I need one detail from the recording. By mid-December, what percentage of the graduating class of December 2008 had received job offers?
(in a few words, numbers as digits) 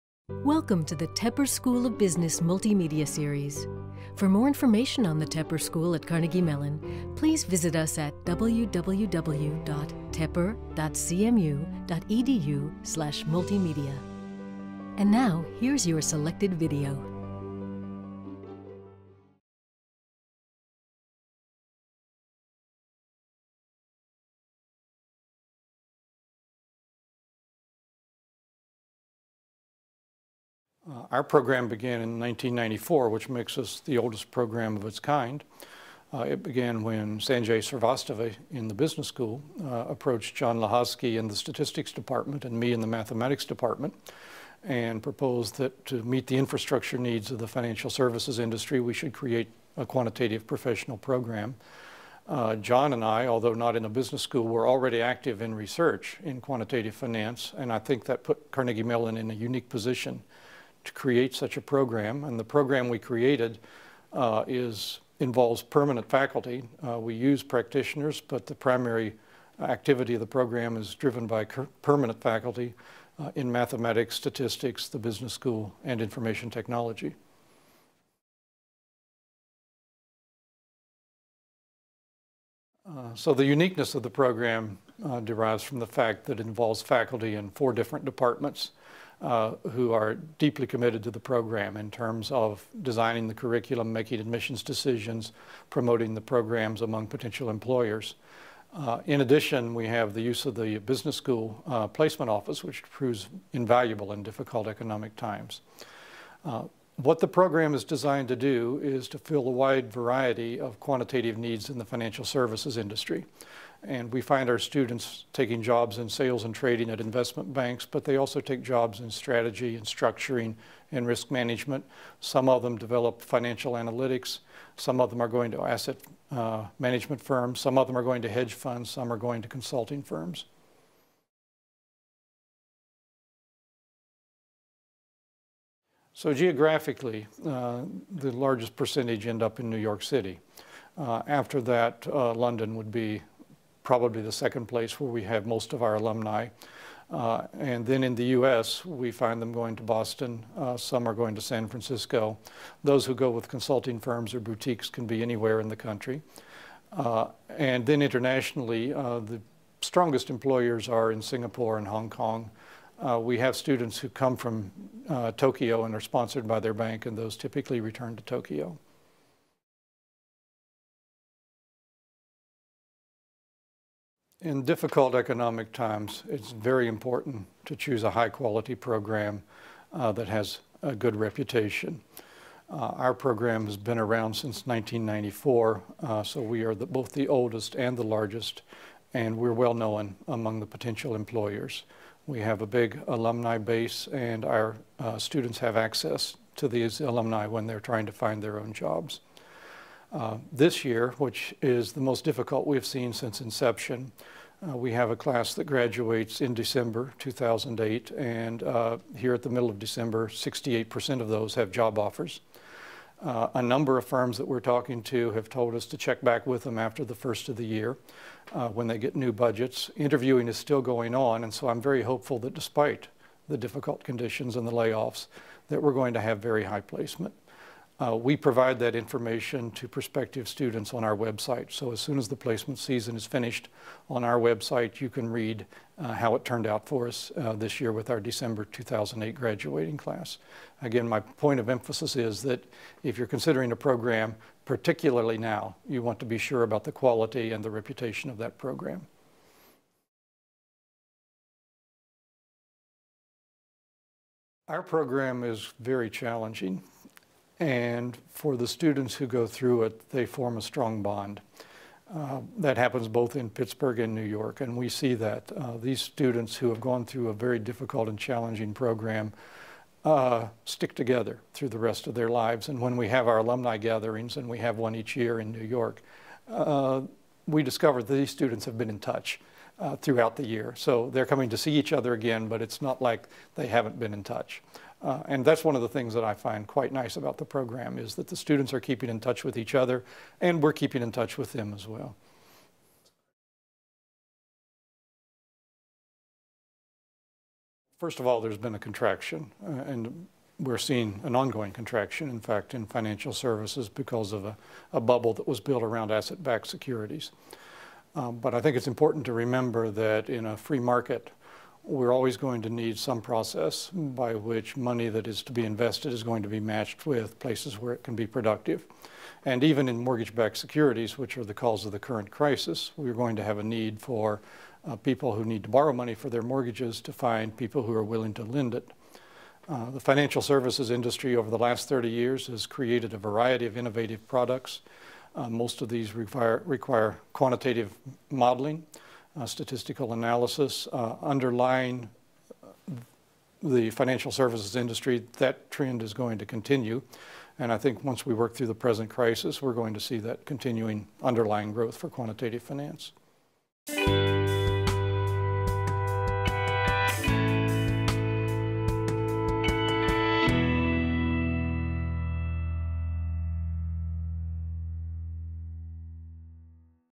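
68%.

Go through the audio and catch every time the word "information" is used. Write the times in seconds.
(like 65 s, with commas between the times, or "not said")
4 s, 76 s, 228 s.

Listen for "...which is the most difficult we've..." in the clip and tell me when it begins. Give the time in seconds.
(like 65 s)
201 s.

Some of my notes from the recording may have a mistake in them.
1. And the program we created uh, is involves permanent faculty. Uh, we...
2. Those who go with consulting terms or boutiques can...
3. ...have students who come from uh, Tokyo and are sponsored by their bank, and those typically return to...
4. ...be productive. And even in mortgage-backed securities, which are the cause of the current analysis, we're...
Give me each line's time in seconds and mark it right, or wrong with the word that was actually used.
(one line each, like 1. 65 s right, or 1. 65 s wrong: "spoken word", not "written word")
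1. 62 s right
2. 152 s wrong: "firms", not "terms"
3. 163 s right
4. 318 s wrong: "crisis", not "analysis".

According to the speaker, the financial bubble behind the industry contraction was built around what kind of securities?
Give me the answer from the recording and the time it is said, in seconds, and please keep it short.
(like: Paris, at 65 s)
asset-backed securities, at 306 s.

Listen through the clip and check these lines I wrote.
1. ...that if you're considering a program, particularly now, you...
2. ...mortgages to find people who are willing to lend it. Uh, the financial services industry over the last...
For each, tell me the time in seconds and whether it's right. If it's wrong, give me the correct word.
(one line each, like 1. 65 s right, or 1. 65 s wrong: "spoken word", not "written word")
1. 242 s right
2. 326 s right.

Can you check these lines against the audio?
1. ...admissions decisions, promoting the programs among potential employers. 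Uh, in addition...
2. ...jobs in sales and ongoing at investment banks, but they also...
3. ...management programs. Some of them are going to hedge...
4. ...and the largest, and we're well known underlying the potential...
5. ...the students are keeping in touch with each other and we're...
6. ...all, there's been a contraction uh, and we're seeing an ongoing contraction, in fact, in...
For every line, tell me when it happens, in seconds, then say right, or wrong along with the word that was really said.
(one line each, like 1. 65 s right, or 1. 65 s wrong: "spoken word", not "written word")
1. 94 s right
2. 115 s wrong: "trading", not "ongoing"
3. 126 s wrong: "firms", not "programs"
4. 187 s wrong: "among", not "underlying"
5. 288 s right
6. 298 s right.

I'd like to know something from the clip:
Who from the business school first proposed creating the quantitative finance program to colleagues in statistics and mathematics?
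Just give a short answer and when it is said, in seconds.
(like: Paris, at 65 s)
Sanjay Srivastava, at 37 s.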